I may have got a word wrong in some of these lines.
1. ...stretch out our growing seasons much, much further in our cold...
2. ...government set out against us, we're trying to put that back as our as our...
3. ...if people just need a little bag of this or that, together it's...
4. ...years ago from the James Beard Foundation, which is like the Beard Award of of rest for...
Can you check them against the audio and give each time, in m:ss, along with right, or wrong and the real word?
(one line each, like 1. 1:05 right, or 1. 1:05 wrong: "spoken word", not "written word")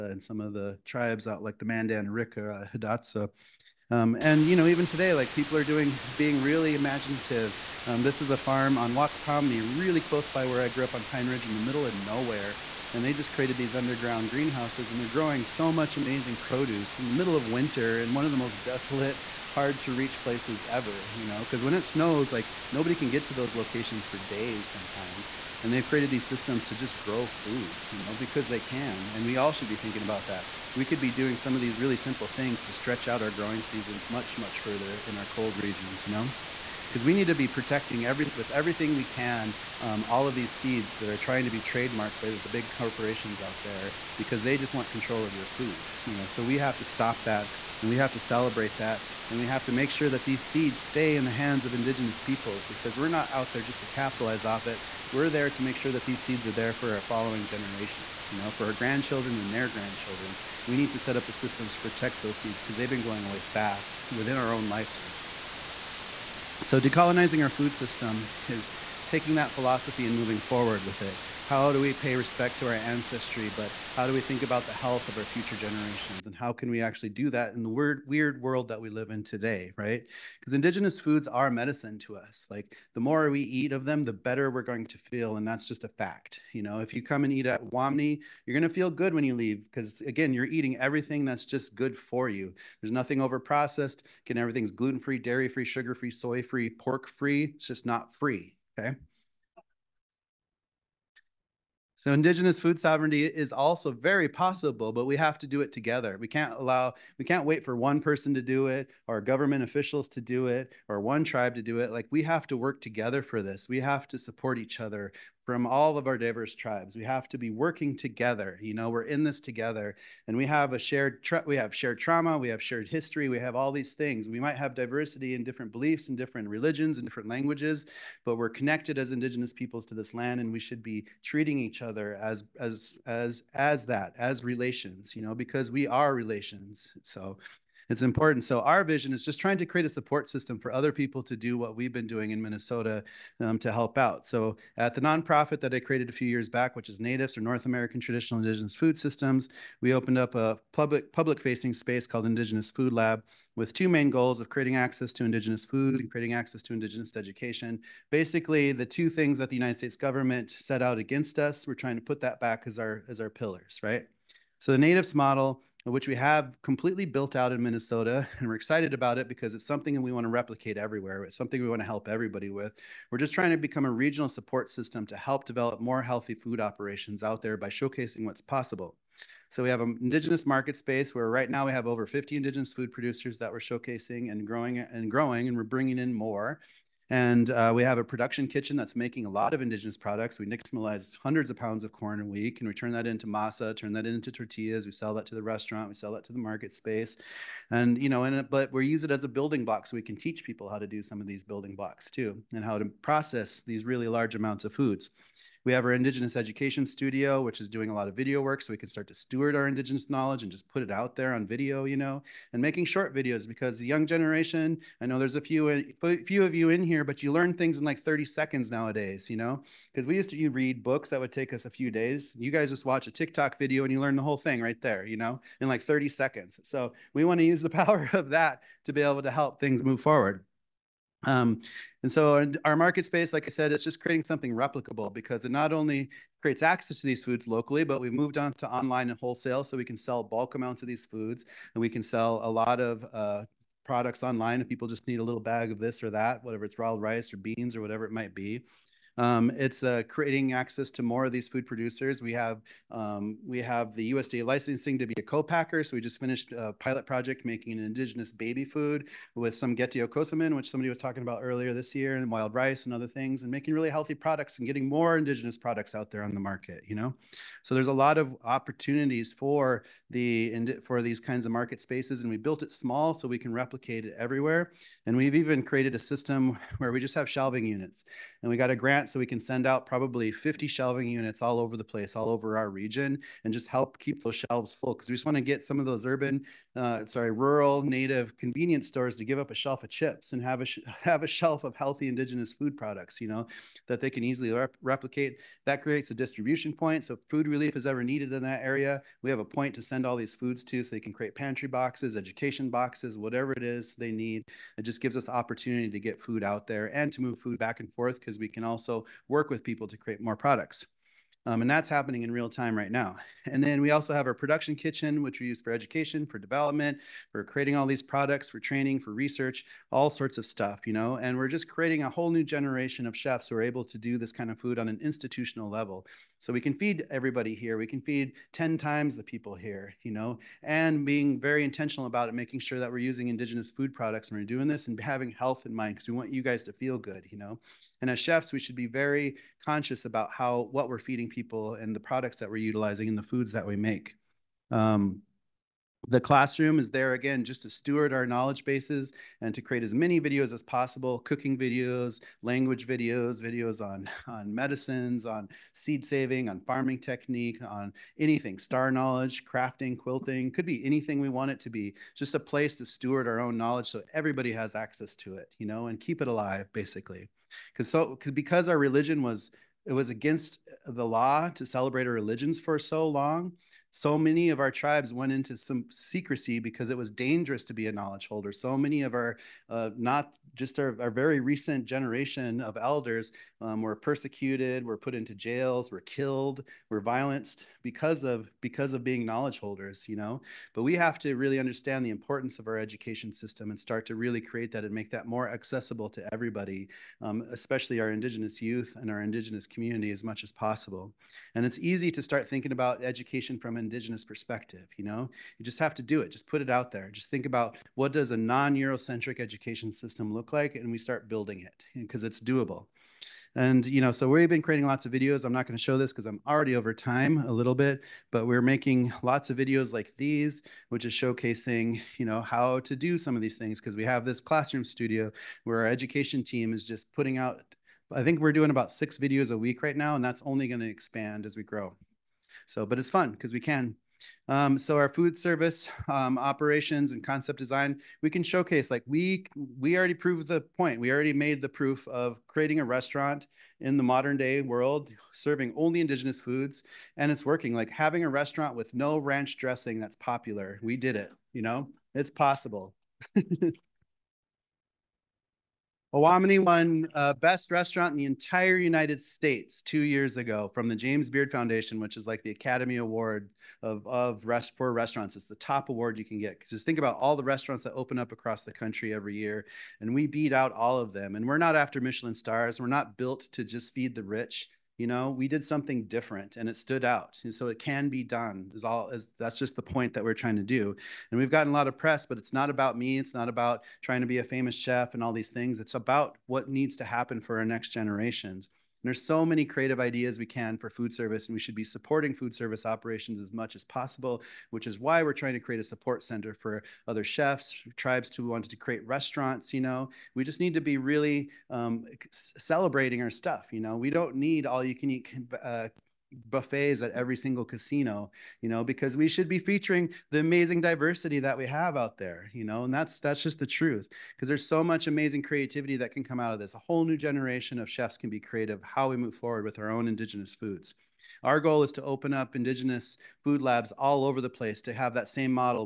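1. 0:32 right
2. 2:39 right
3. 4:04 wrong: "whatever", not "together"
4. 7:39 wrong: "Academy", not "Beard".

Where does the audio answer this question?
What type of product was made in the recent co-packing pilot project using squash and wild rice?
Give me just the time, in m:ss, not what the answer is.
4:18.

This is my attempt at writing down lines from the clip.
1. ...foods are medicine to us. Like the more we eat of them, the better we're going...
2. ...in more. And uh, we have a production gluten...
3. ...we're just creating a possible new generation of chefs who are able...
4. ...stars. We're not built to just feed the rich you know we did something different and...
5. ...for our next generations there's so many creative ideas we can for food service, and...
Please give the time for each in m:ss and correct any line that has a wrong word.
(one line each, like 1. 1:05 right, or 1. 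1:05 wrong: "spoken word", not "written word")
1. 1:20 right
2. 3:05 wrong: "kitchen", not "gluten"
3. 5:21 wrong: "whole", not "possible"
4. 7:52 right
5. 8:07 right.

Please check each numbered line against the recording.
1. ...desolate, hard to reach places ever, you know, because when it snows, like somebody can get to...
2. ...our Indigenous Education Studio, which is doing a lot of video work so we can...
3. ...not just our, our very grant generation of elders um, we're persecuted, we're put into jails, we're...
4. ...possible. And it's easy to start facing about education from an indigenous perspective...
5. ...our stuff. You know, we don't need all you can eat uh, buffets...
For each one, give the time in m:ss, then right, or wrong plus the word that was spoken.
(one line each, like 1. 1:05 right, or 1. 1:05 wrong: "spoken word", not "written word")
1. 0:18 wrong: "nobody", not "somebody"
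2. 3:25 right
3. 6:19 wrong: "recent", not "grant"
4. 6:40 wrong: "thinking", not "facing"
5. 8:23 right.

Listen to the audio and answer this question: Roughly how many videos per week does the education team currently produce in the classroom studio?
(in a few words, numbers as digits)
6.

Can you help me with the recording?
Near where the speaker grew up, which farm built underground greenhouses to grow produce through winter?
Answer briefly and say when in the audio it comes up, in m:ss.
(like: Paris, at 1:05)
Wakpamni, at 0:08.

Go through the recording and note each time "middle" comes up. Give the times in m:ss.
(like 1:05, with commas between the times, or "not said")
0:11, 0:17.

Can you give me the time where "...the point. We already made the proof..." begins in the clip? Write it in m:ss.
7:20.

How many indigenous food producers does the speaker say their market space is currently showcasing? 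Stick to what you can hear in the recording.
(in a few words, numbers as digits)
over 50.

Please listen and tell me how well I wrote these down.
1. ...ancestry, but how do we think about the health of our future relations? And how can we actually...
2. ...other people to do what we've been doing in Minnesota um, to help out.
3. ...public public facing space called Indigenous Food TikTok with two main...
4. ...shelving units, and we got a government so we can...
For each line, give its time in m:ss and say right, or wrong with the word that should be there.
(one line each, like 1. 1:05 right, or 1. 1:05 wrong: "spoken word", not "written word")
1. 1:12 wrong: "generations", not "relations"
2. 2:20 right
3. 2:30 wrong: "Lab", not "TikTok"
4. 4:37 wrong: "grant", not "government".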